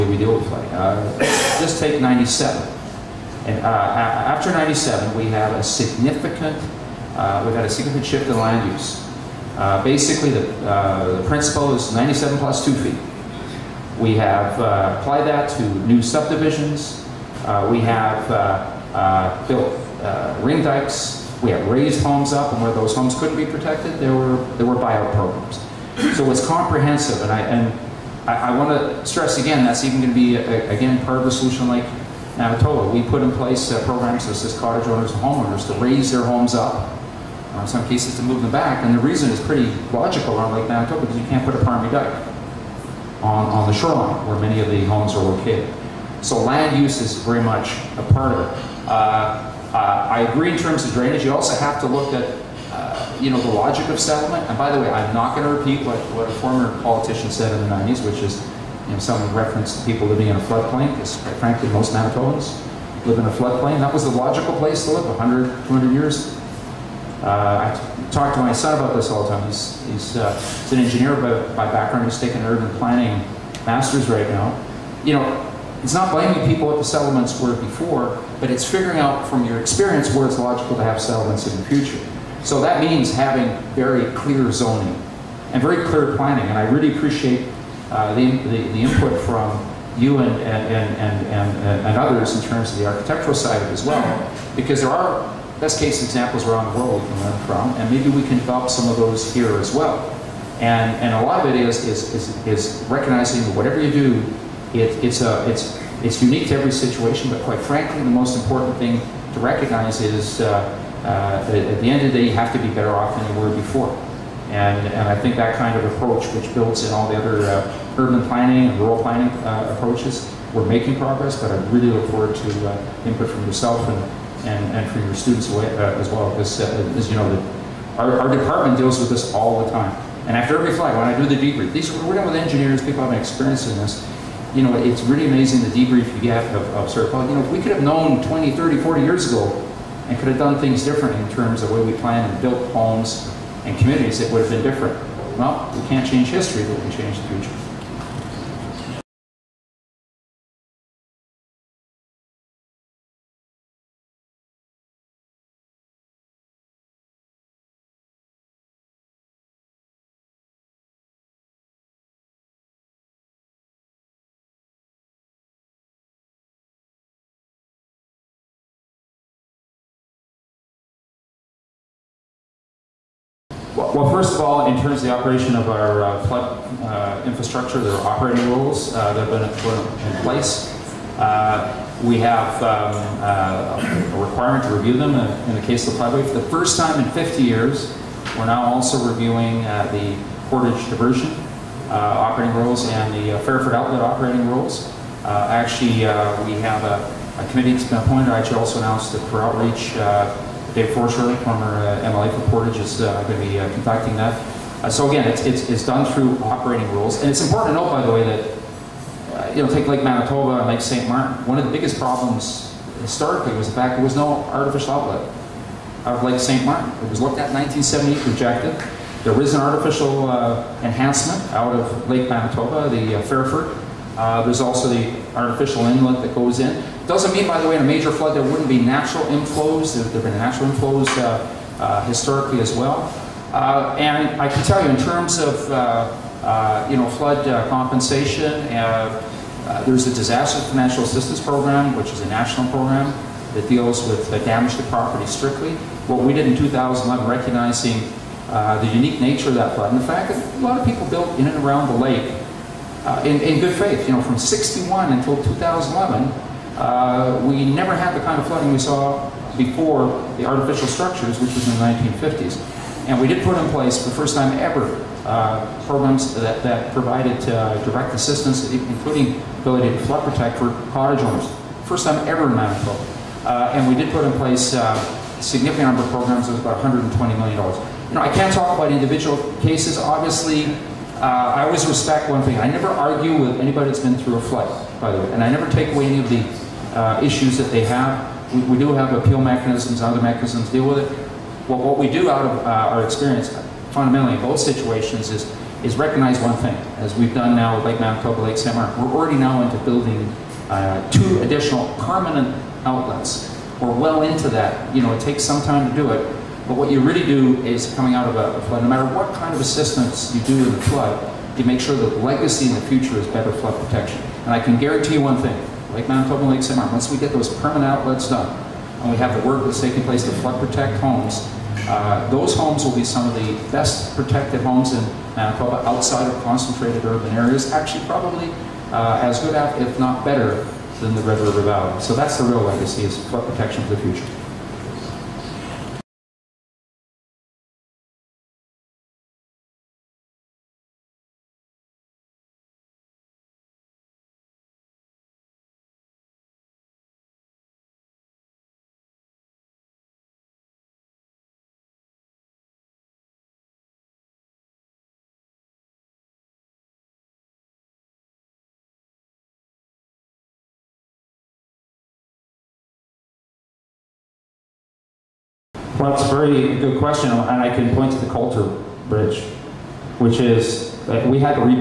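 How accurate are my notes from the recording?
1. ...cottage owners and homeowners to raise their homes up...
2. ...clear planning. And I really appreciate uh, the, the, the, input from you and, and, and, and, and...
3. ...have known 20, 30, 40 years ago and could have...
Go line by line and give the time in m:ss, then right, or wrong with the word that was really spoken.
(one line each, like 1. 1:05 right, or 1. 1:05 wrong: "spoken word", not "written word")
1. 0:34 right
2. 1:25 right
3. 2:17 right.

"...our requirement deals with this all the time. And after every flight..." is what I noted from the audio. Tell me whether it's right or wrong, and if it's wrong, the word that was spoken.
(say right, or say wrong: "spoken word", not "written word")
wrong: "department", not "requirement".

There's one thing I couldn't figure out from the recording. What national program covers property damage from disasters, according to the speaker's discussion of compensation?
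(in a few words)
Disaster Financial Assistance Program.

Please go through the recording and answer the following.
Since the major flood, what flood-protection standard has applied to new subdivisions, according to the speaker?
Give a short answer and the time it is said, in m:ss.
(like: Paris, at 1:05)
97 plus two feet, at 0:11.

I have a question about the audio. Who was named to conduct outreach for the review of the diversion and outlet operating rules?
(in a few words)
Dave Faurschou.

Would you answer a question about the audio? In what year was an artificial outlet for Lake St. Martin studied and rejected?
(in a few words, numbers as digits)
1978.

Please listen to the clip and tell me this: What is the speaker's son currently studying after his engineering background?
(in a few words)
urban planning master's.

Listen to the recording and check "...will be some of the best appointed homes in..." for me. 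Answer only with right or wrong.
wrong.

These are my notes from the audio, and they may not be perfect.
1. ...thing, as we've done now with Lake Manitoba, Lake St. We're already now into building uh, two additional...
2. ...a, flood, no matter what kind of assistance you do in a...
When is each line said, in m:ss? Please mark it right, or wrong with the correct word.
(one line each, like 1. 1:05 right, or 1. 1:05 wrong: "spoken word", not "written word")
1. 4:56 right
2. 5:08 right.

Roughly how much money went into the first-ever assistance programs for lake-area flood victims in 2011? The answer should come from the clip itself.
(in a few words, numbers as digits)
$120 million.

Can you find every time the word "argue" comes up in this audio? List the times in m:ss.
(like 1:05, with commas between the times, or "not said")
4:42.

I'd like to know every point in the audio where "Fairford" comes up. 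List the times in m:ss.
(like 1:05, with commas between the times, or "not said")
3:13, 3:43.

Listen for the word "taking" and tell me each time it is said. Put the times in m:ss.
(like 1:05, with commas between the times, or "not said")
1:12, 5:19.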